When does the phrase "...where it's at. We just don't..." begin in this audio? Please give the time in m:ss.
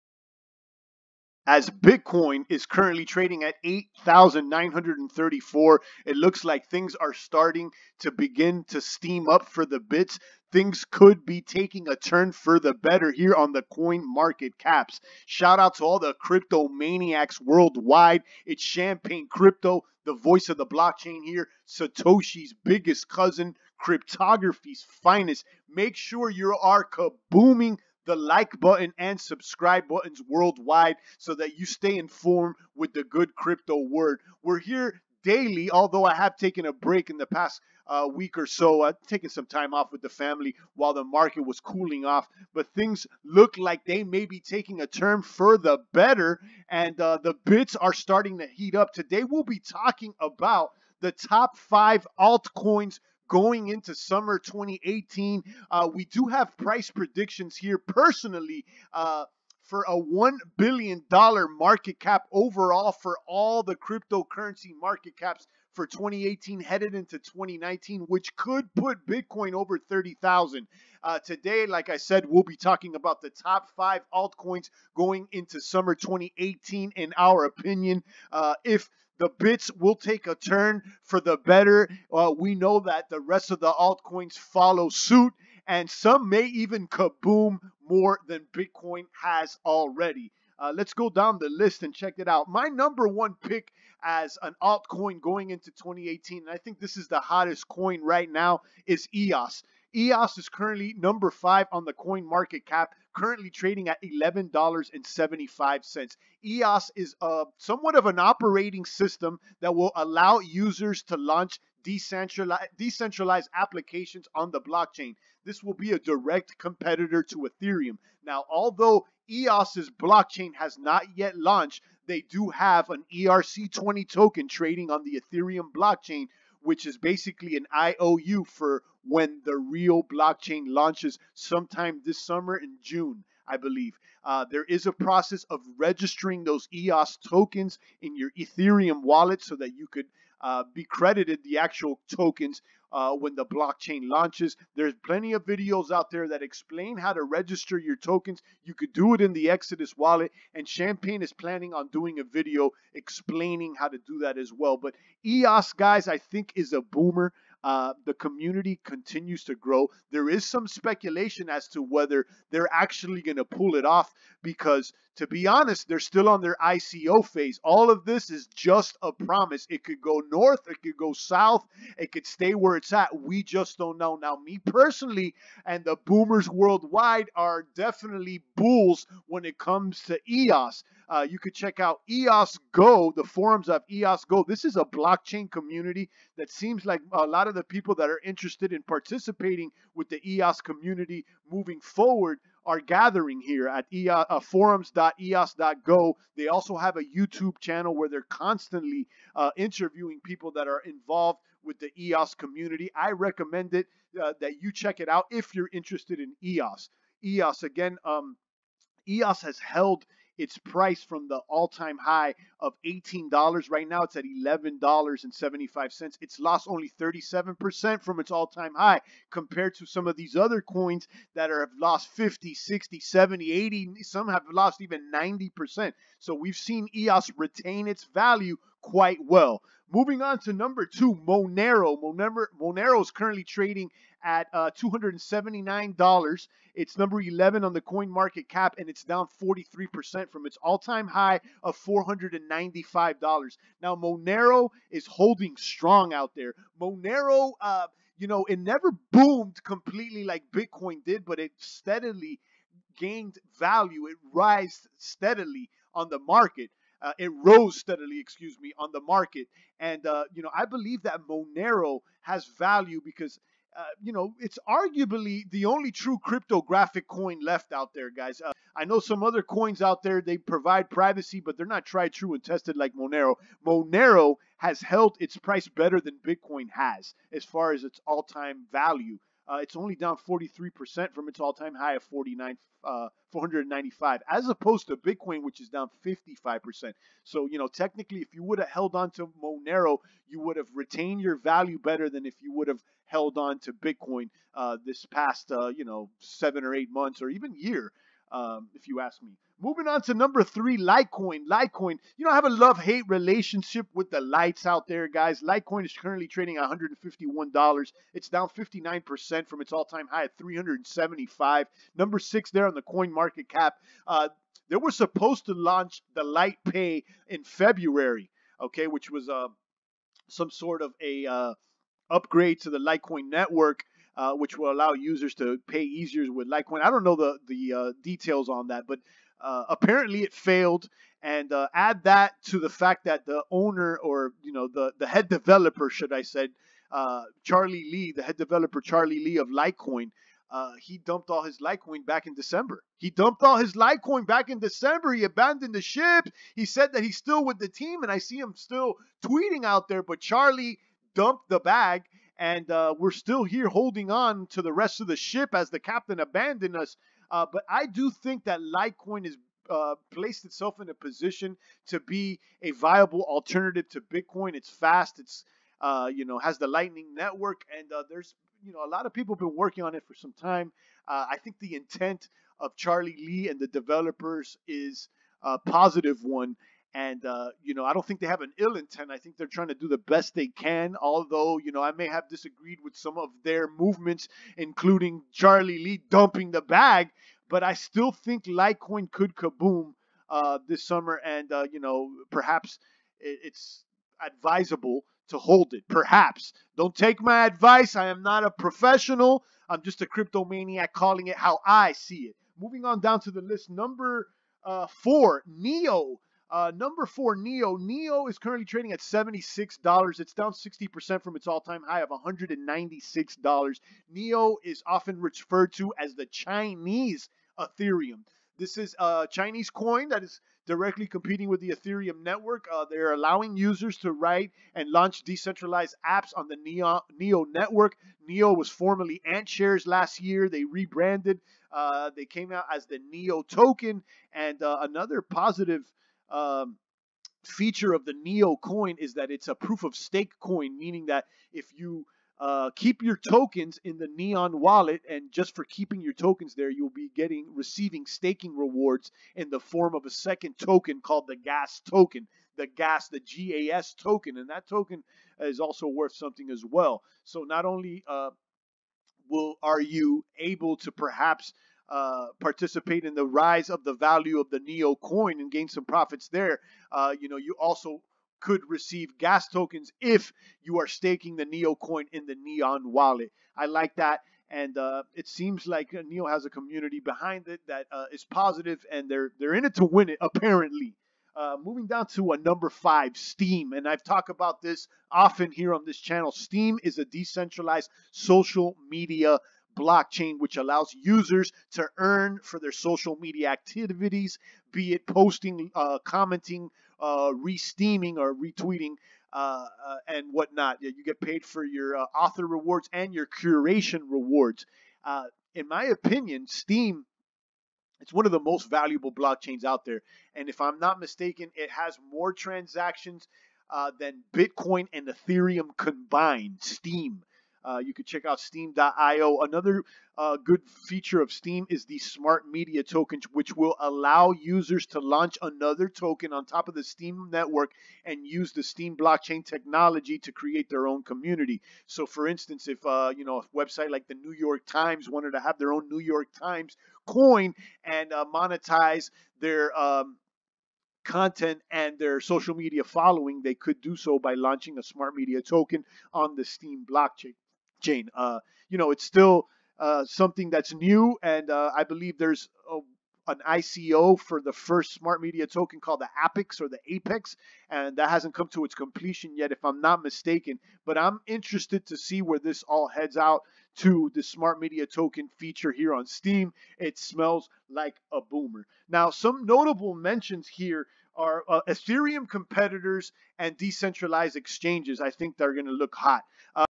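2:52.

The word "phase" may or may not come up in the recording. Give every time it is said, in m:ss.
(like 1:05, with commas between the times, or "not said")
2:47.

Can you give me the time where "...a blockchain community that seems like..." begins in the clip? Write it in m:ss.
3:04.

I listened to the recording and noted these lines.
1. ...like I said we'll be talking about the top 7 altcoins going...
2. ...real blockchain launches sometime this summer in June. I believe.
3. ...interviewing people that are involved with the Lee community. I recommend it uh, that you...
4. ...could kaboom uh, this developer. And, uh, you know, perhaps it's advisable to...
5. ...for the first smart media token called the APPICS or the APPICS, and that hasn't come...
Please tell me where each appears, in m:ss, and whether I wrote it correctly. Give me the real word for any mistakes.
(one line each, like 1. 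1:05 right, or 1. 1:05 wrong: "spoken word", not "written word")
1. 1:11 wrong: "5", not "7"
2. 2:09 right
3. 3:19 wrong: "EOS", not "Lee"
4. 6:29 wrong: "summer", not "developer"
5. 9:14 right.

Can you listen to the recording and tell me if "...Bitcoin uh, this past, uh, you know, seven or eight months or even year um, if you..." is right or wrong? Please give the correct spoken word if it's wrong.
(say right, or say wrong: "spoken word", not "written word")
right.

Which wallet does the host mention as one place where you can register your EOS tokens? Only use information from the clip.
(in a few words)
Exodus.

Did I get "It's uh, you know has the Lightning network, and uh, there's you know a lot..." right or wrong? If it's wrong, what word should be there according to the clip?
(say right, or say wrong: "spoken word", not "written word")
right.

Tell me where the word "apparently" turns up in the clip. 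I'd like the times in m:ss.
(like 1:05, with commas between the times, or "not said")
5:29, 8:00.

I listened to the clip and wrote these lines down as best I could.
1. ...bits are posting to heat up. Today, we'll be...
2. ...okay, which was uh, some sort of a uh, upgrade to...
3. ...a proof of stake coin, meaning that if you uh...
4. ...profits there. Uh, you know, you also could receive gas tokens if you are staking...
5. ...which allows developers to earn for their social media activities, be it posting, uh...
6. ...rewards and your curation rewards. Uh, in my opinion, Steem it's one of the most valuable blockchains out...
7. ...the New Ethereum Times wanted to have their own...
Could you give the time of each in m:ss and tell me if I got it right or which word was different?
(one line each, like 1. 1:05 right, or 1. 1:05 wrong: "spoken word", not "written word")
1. 0:47 wrong: "starting", not "posting"
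2. 5:18 right
3. 7:19 right
4. 7:45 right
5. 8:10 wrong: "users", not "developers"
6. 8:22 right
7. 8:54 wrong: "York", not "Ethereum".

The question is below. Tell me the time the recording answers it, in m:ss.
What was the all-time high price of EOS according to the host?
3:32.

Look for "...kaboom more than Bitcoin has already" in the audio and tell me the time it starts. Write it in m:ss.
1:26.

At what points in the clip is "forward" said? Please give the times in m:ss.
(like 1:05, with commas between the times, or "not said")
3:11.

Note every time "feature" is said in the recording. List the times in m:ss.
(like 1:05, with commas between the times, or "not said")
7:17, 8:40, 9:25.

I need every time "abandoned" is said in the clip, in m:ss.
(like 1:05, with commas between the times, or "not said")
5:45, 5:56.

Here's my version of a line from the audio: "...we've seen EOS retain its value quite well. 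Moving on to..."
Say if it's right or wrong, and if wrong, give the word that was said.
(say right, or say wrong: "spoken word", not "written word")
right.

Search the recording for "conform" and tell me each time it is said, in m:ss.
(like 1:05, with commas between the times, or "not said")
not said.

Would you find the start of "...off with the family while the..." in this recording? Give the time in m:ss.
0:39.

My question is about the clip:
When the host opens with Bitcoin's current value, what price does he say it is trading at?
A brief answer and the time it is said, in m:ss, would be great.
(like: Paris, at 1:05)
8,934, at 0:03.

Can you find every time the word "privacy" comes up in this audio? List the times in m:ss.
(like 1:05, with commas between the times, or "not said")
4:30.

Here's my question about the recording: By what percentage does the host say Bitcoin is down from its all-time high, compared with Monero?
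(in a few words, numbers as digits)
55%.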